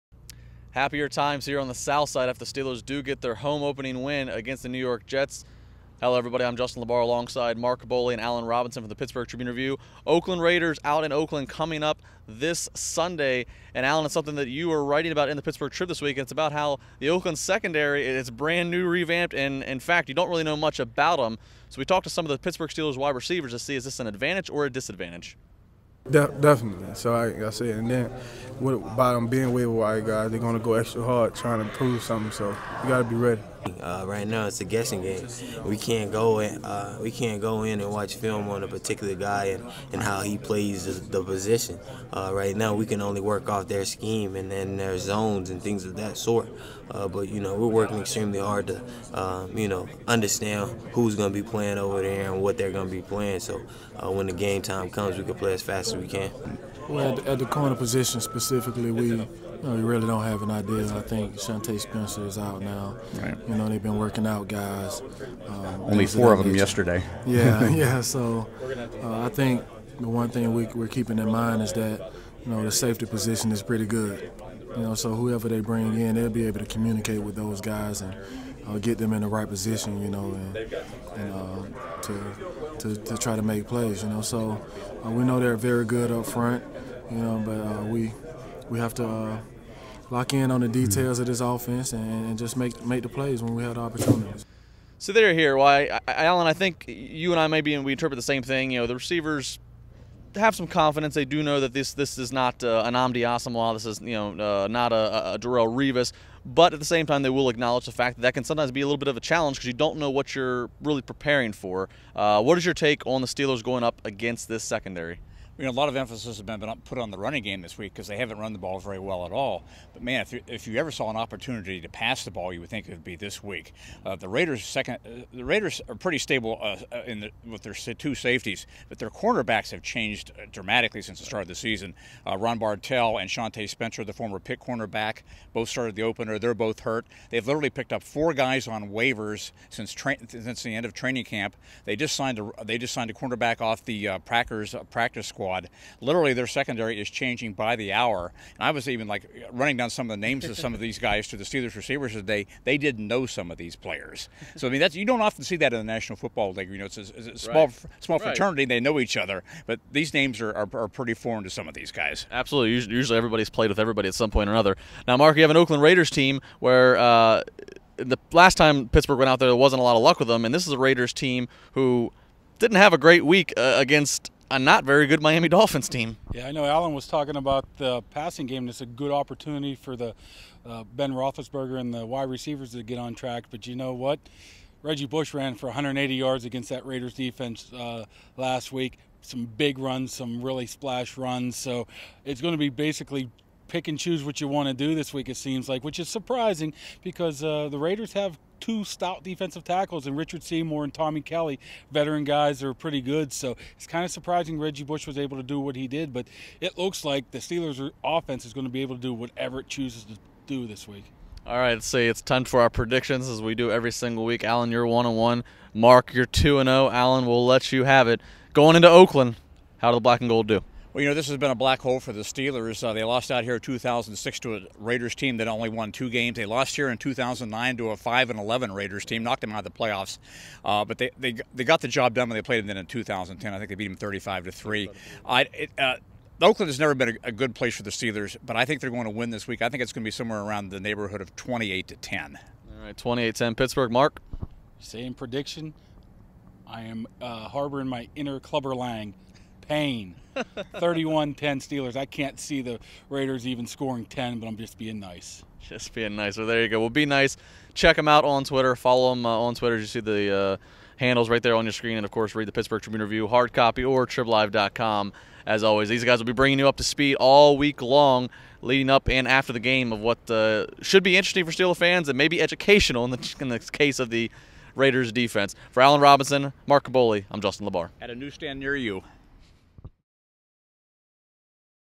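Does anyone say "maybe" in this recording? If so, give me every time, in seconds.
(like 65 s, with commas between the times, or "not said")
97 s, 272 s.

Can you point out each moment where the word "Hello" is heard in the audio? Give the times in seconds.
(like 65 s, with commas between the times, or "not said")
5 s.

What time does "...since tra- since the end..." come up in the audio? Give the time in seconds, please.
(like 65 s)
139 s.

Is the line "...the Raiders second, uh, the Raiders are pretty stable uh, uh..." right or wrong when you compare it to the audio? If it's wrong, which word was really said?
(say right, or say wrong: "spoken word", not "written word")
right.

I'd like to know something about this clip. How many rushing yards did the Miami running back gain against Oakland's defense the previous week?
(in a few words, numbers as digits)
180.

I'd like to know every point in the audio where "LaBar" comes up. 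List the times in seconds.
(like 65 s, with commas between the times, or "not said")
6 s, 277 s.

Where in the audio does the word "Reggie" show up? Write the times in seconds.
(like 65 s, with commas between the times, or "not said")
184 s, 204 s.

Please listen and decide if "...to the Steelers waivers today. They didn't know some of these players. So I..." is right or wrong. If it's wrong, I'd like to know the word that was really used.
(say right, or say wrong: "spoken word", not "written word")
wrong: "receivers", not "waivers".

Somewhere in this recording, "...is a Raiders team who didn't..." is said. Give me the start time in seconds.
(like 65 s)
170 s.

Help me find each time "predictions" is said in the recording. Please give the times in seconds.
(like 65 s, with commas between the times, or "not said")
212 s, 245 s.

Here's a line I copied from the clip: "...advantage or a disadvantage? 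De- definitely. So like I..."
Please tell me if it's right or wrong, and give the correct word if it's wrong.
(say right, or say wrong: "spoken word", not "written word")
right.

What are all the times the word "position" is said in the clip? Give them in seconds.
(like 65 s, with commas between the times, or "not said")
41 s, 57 s, 73 s, 79 s.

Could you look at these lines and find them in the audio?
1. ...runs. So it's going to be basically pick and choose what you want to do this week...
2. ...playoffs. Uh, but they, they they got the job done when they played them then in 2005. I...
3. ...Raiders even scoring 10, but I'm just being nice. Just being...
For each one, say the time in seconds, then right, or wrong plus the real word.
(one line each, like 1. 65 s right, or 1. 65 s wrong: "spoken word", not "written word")
1. 191 s right
2. 229 s wrong: "2010", not "2005"
3. 253 s right.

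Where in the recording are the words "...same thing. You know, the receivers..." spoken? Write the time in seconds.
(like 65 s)
98 s.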